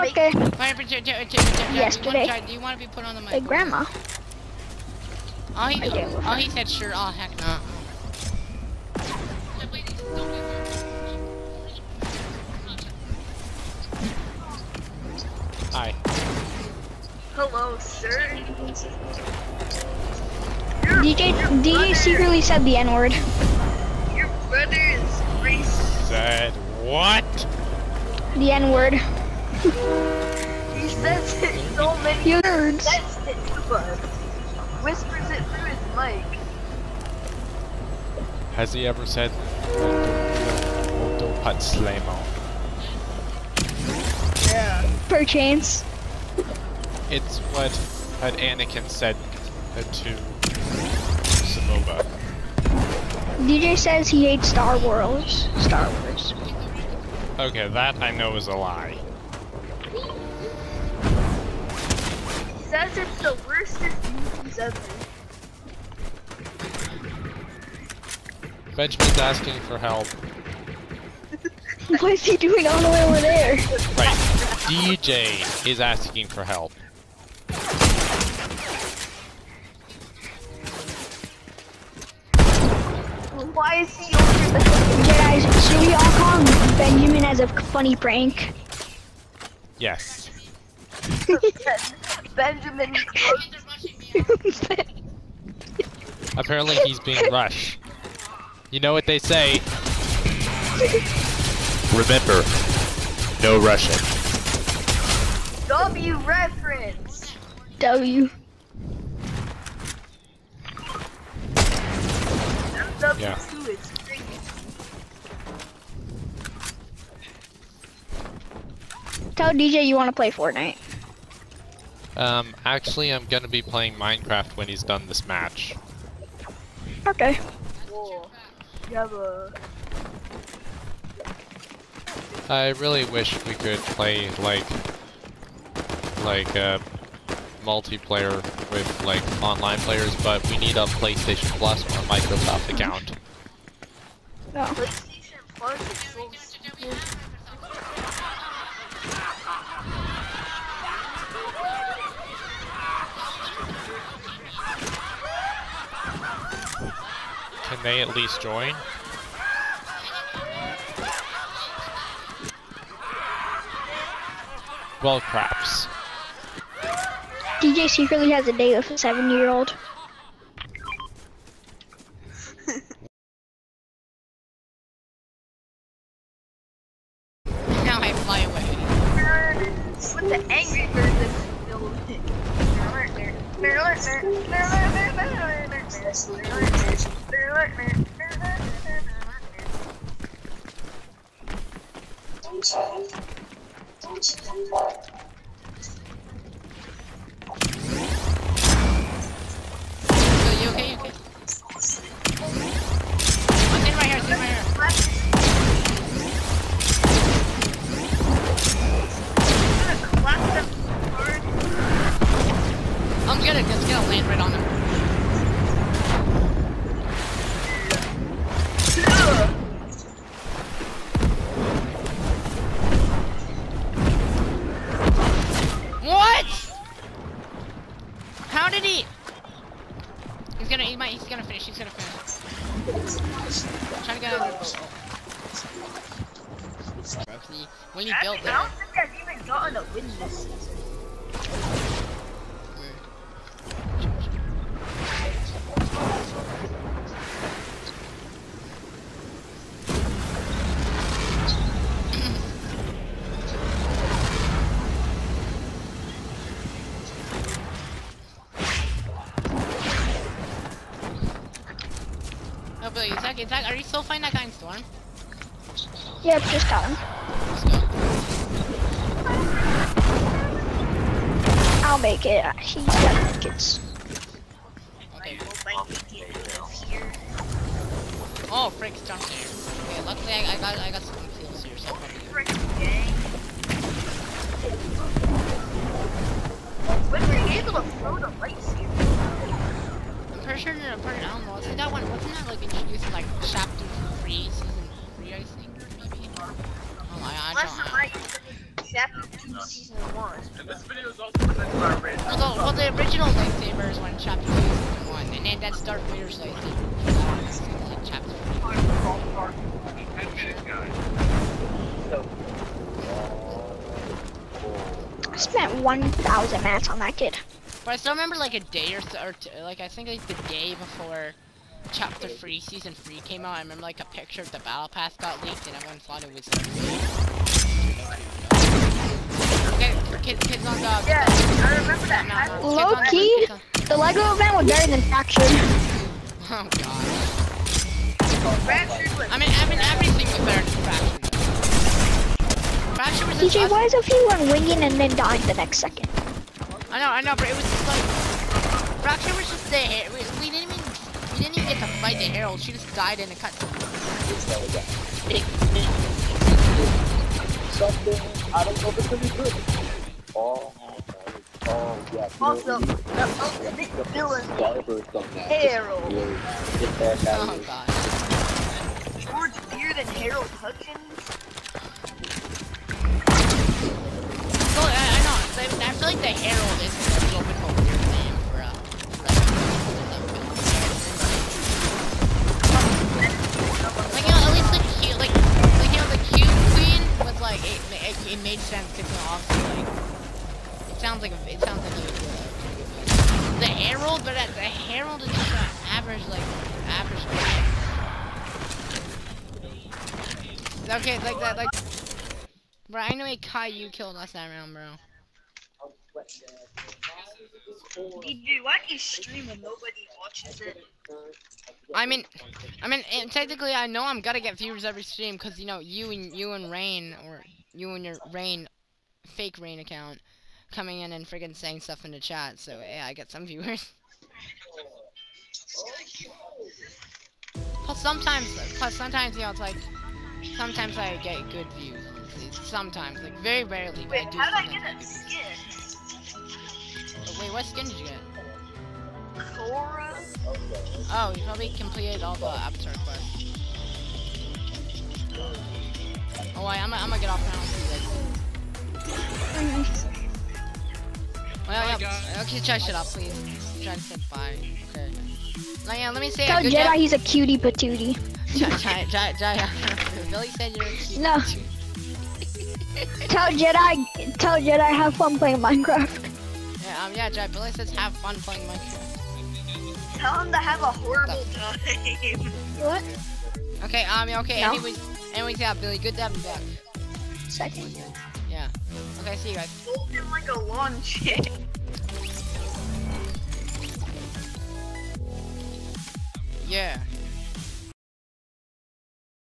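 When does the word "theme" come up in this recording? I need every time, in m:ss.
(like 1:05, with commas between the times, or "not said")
not said.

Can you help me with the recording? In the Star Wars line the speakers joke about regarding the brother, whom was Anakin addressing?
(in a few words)
Sebulba.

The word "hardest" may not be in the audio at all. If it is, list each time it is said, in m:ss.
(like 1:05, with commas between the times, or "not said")
not said.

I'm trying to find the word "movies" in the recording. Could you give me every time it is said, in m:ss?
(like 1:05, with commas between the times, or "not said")
1:04.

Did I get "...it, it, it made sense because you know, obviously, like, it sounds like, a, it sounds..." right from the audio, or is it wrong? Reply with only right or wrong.
right.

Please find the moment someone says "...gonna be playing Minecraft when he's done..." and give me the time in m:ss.
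2:03.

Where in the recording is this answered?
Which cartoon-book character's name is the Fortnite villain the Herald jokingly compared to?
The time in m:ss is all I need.
6:10.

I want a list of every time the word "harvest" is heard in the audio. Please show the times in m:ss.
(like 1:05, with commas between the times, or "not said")
not said.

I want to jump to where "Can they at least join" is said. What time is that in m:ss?
2:37.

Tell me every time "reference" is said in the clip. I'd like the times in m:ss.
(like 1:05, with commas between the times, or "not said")
1:46.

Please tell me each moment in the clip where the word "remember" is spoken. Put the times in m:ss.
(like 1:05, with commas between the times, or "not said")
1:41, 5:18, 5:23, 5:31.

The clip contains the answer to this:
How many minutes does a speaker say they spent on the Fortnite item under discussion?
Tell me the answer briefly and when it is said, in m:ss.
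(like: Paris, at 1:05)
1,000, at 5:15.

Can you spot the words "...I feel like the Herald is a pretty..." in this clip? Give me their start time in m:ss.
6:15.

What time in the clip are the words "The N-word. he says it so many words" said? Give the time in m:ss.
0:28.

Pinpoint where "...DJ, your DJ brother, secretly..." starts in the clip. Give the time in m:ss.
0:21.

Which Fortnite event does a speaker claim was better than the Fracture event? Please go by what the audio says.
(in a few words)
The Lego event.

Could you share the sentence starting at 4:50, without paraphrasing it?
pretty sure they're part of Elmo.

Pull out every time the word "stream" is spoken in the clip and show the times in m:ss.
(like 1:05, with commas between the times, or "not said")
6:48, 6:55.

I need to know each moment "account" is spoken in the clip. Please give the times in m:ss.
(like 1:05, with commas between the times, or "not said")
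2:22, 6:59.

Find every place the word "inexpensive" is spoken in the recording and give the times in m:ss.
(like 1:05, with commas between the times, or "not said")
not said.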